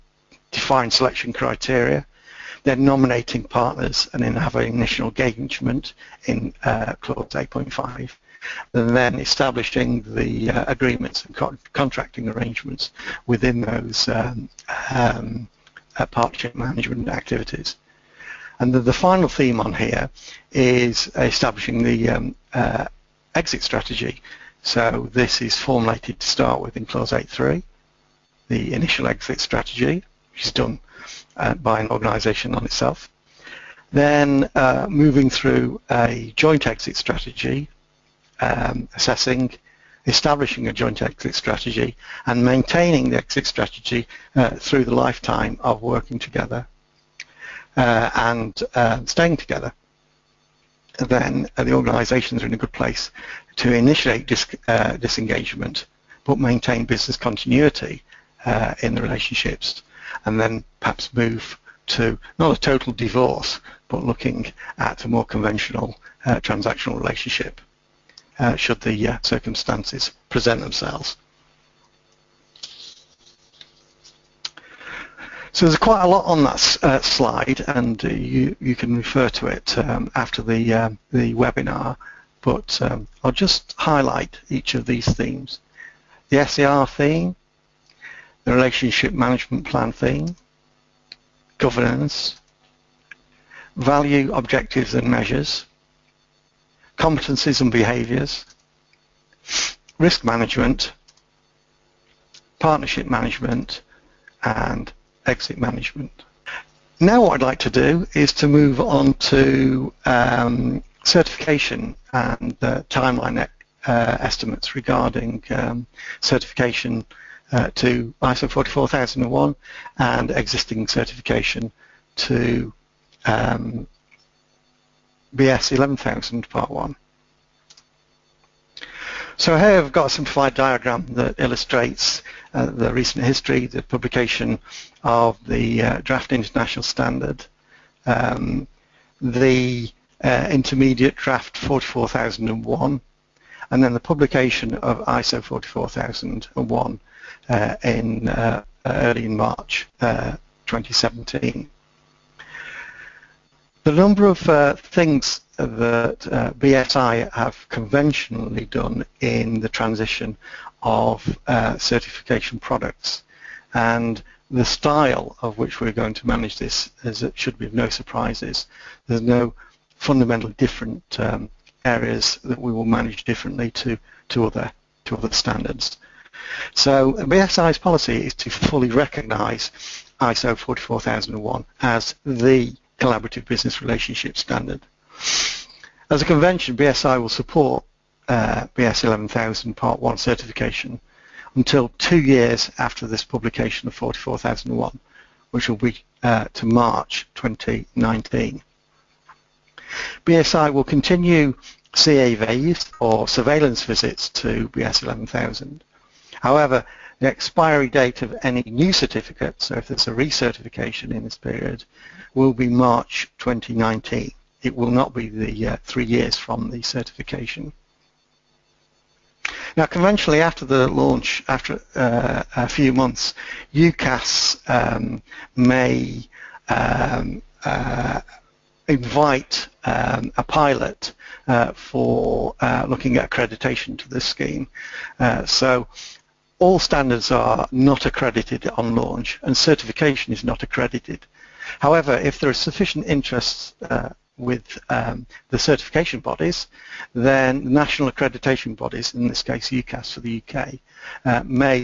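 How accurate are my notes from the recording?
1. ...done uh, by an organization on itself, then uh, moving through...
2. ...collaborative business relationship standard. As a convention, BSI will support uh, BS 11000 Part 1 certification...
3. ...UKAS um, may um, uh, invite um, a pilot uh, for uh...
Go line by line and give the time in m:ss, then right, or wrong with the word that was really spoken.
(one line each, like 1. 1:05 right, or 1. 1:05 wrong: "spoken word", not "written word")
1. 0:30 right
2. 3:02 right
3. 3:43 right.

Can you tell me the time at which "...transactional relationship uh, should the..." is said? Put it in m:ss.
1:06.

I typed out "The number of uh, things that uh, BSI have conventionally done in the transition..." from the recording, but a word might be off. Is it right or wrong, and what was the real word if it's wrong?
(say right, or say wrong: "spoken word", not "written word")
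right.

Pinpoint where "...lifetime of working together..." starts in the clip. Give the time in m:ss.
0:45.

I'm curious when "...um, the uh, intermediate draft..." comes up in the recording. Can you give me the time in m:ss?
2:18.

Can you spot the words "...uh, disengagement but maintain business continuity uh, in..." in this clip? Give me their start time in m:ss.
0:54.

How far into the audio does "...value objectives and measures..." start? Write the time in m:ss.
1:33.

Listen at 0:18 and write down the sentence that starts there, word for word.
And the, the, final theme on here is establishing the um, uh, exit strategy.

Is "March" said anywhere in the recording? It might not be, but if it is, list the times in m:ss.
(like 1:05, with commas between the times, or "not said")
2:29, 3:16, 3:32.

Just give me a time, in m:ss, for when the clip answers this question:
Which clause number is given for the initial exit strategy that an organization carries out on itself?
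0:26.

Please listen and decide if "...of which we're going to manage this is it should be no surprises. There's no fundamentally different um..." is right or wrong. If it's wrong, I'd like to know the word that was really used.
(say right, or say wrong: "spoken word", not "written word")
right.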